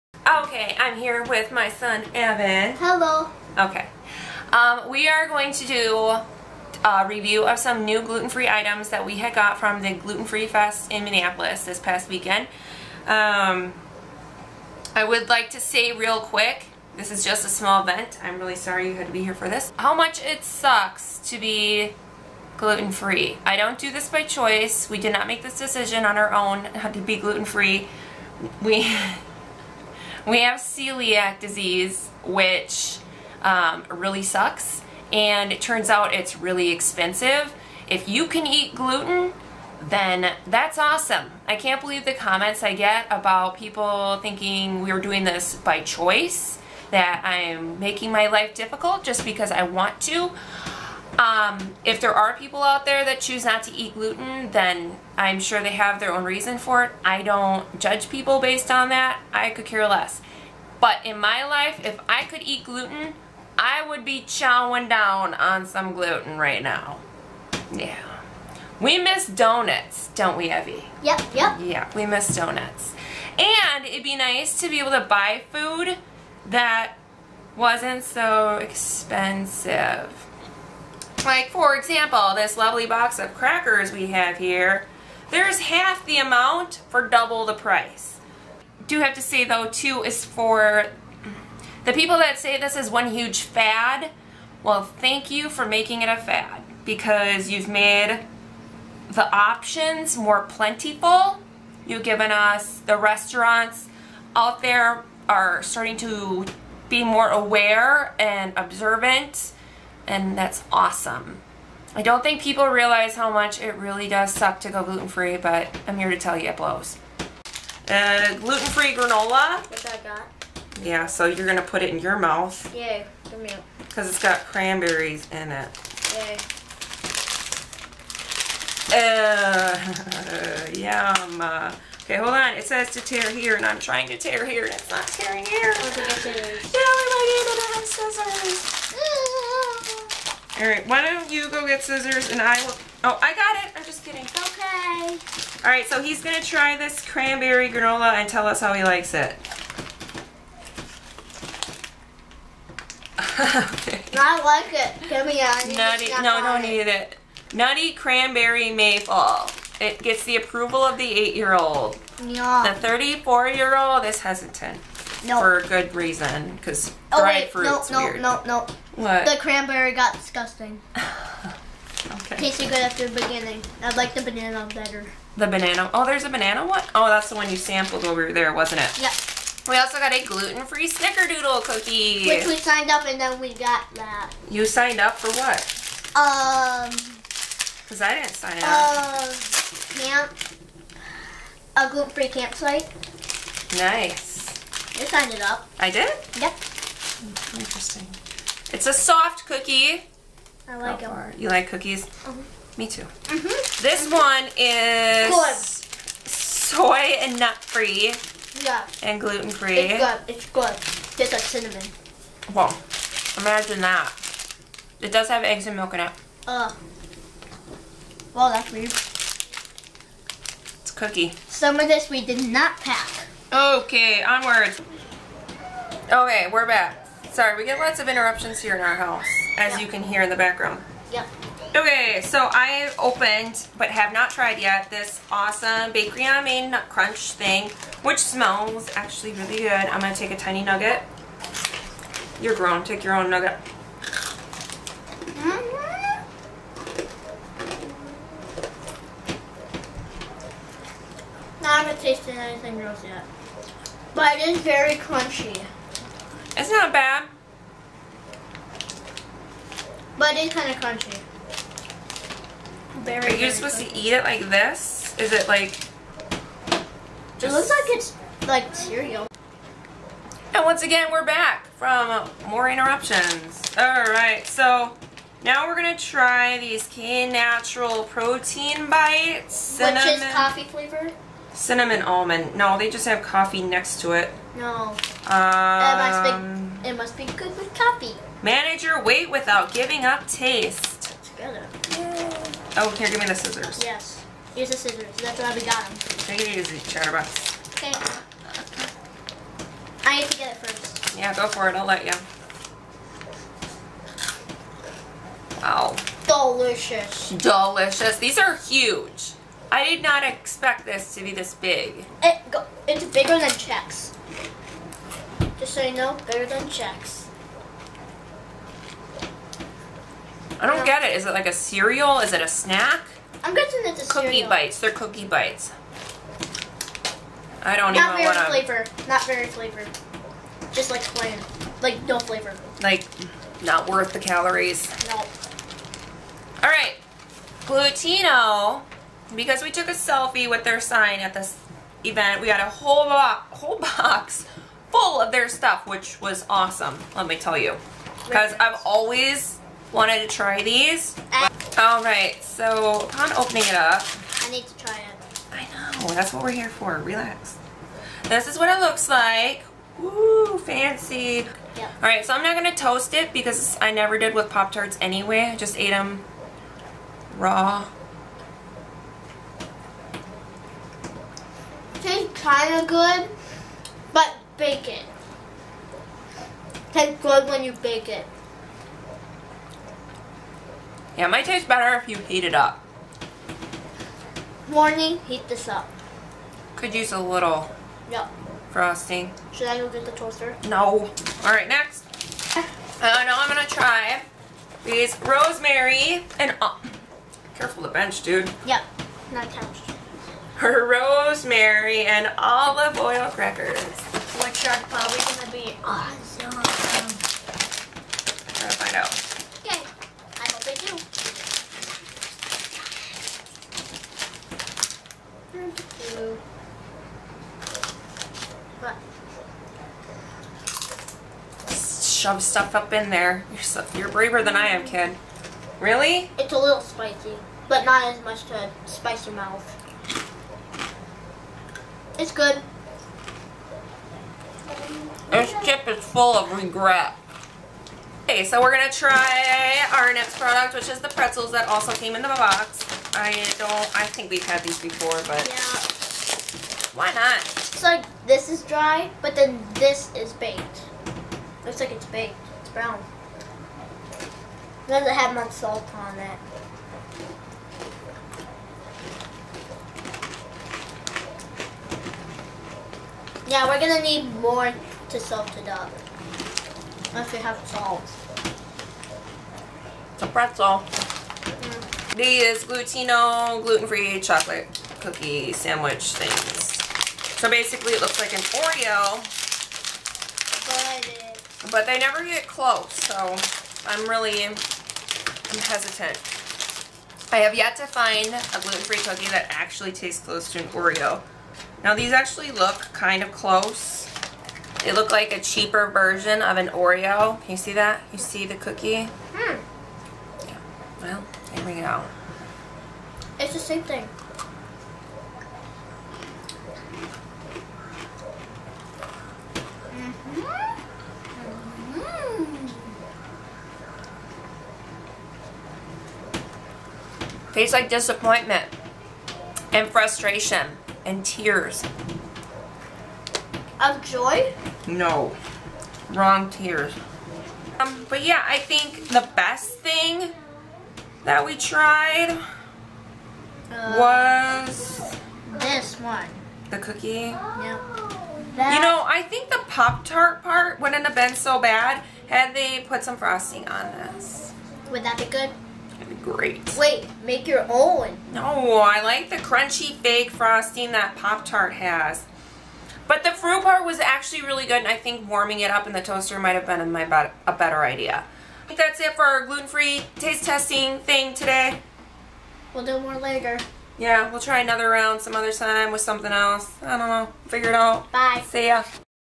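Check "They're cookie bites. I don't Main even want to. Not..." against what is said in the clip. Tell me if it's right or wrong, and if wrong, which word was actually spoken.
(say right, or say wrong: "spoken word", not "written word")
wrong: "Not", not "Main".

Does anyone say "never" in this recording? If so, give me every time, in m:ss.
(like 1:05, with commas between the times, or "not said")
6:03, 8:01.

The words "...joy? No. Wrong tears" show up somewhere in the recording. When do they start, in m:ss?
8:44.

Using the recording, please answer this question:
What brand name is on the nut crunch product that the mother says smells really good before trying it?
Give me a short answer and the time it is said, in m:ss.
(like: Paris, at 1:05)
Bakery on Main, at 3:55.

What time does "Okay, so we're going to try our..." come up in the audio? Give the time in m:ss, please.
7:18.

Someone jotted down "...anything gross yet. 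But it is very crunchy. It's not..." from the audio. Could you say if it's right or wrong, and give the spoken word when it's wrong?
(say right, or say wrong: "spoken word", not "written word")
right.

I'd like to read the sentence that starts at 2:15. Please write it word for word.
Yeah, we might even have scissors.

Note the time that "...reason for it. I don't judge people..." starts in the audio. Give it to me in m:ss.
0:56.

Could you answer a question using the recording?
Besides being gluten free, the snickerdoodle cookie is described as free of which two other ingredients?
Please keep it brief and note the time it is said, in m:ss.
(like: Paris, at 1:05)
Soy and nut, at 3:26.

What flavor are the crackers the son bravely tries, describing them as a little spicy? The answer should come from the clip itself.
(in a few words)
Rosemary and olive oil.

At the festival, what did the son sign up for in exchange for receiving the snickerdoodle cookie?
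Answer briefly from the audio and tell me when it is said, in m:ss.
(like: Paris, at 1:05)
A gluten-free campsite, at 3:11.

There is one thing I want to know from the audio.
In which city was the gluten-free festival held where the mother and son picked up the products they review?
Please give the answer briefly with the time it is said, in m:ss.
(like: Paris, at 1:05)
Minneapolis, at 0:11.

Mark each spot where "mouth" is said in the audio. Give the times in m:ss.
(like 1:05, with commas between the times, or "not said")
2:02, 7:09.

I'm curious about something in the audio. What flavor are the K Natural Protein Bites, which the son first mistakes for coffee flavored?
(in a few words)
Cinnamon almond.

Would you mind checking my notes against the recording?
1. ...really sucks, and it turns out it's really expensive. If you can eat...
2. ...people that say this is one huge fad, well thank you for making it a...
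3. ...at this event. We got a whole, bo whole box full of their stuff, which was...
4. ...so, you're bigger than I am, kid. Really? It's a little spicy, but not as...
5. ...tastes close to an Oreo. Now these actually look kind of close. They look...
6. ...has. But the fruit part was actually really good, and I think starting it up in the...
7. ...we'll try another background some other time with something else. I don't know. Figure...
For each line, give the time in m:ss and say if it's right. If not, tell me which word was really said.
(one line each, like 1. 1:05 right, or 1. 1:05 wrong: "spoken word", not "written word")
1. 0:33 right
2. 1:31 right
3. 5:41 right
4. 7:03 wrong: "braver", not "bigger"
5. 8:09 right
6. 9:11 wrong: "warming", not "starting"
7. 9:24 wrong: "round", not "background".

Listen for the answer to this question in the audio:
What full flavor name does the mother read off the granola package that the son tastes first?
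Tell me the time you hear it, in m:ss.
2:37.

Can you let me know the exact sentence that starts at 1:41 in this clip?
You've given us the restaurants out there are starting to be more aware and observant and that's awesome.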